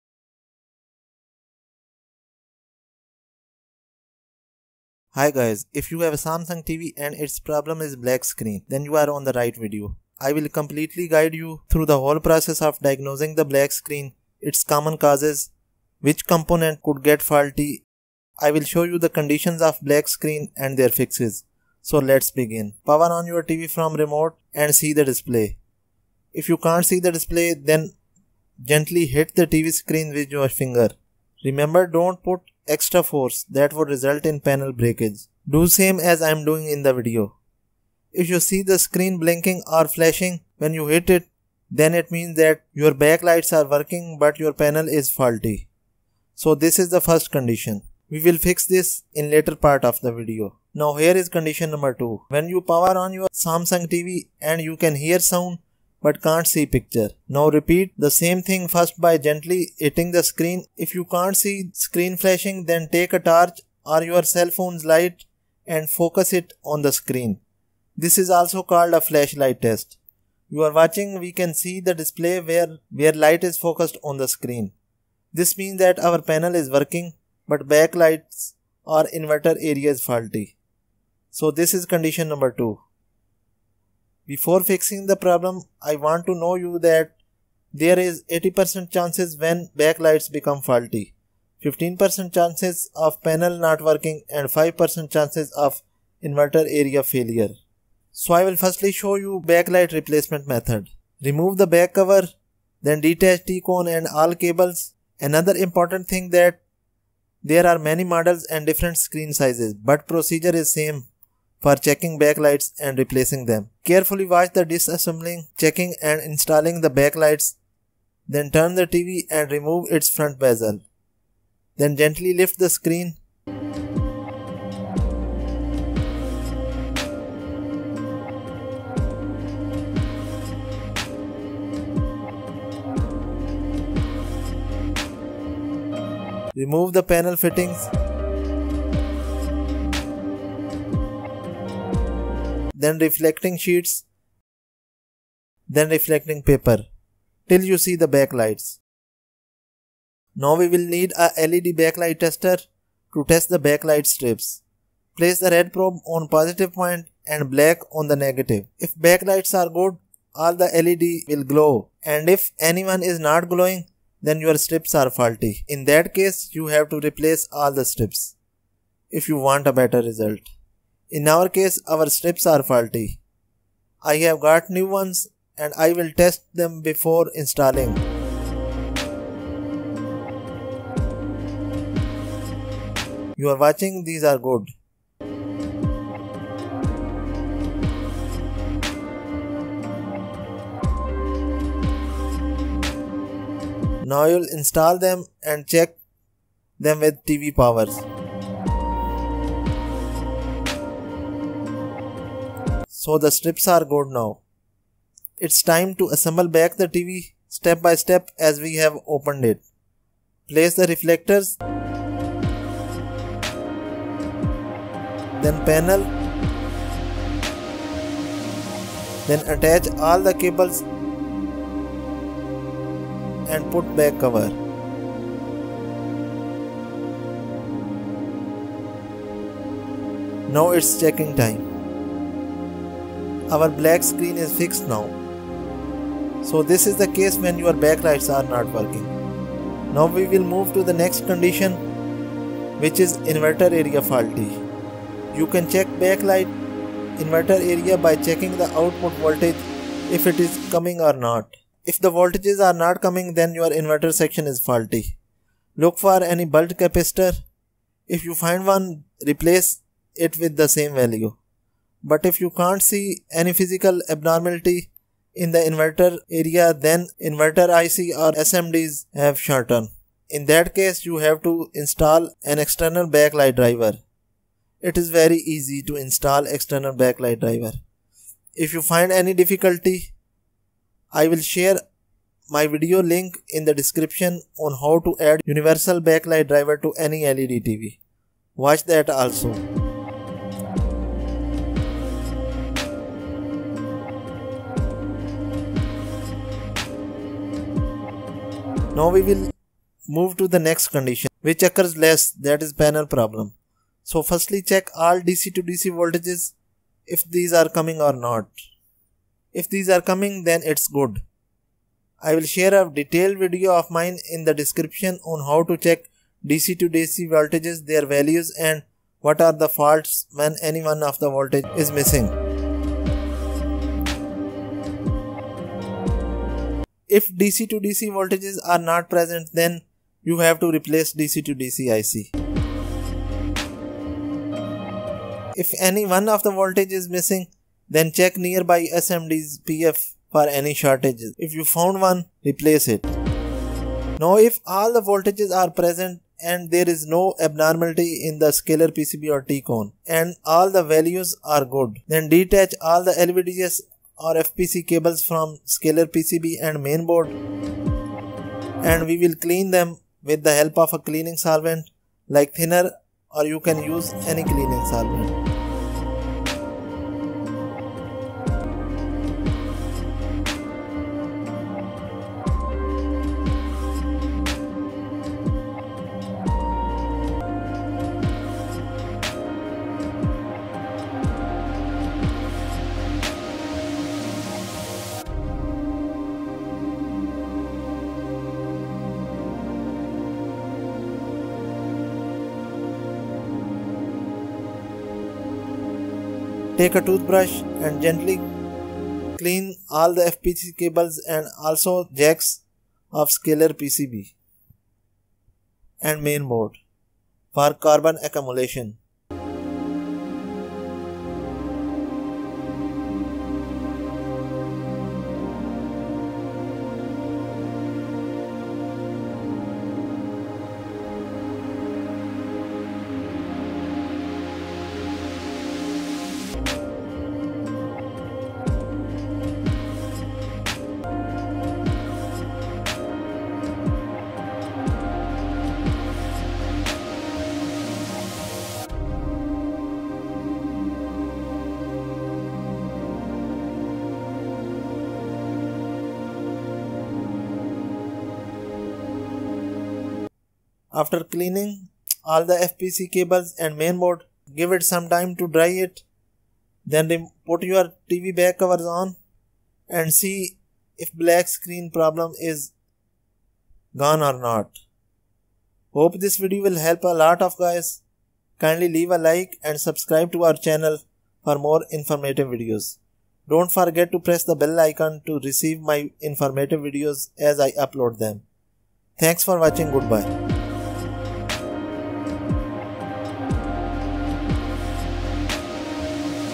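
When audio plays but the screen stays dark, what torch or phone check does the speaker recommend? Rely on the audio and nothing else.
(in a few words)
Flashlight test.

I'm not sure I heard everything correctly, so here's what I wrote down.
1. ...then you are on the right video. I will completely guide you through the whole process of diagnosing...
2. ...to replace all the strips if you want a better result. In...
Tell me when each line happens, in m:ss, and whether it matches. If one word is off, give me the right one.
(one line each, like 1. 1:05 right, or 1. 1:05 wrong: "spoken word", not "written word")
1. 0:08 right
2. 2:46 right.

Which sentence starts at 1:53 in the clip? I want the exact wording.
Carefully watch the disassembling, checking and installing the backlights.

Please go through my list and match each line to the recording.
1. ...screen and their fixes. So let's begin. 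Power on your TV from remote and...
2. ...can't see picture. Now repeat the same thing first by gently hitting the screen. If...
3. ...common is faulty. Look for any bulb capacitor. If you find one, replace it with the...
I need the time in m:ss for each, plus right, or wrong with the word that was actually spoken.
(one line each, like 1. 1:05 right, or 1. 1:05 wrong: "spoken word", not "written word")
1. 0:20 right
2. 0:56 right
3. 4:14 wrong: "section", not "common".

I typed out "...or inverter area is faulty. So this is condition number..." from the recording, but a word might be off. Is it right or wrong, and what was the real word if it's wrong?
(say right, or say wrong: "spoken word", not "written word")
right.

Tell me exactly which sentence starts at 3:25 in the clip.
It's time to assemble back the TV step by step as we have opened it.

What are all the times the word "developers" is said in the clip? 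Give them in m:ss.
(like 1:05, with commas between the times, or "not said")
not said.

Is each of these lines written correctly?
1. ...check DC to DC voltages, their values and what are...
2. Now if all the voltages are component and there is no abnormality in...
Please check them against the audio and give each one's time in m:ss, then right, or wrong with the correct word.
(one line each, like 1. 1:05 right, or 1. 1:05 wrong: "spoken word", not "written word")
1. 5:15 right
2. 5:44 wrong: "present", not "component".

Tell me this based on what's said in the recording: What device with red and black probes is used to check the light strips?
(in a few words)
LED backlight tester.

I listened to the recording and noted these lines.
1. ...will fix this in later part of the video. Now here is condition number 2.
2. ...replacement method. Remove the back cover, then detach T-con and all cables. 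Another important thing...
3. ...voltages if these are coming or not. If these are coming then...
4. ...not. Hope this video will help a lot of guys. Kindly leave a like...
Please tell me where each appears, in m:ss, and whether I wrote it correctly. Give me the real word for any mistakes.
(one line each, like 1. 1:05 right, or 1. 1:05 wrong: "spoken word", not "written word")
1. 0:48 right
2. 1:39 right
3. 5:05 right
4. 7:44 right.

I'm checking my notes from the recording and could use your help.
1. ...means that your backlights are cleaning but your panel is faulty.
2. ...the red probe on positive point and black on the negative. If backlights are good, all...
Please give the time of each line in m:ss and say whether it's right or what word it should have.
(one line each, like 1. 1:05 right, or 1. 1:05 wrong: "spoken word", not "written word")
1. 0:42 wrong: "working", not "cleaning"
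2. 2:35 right.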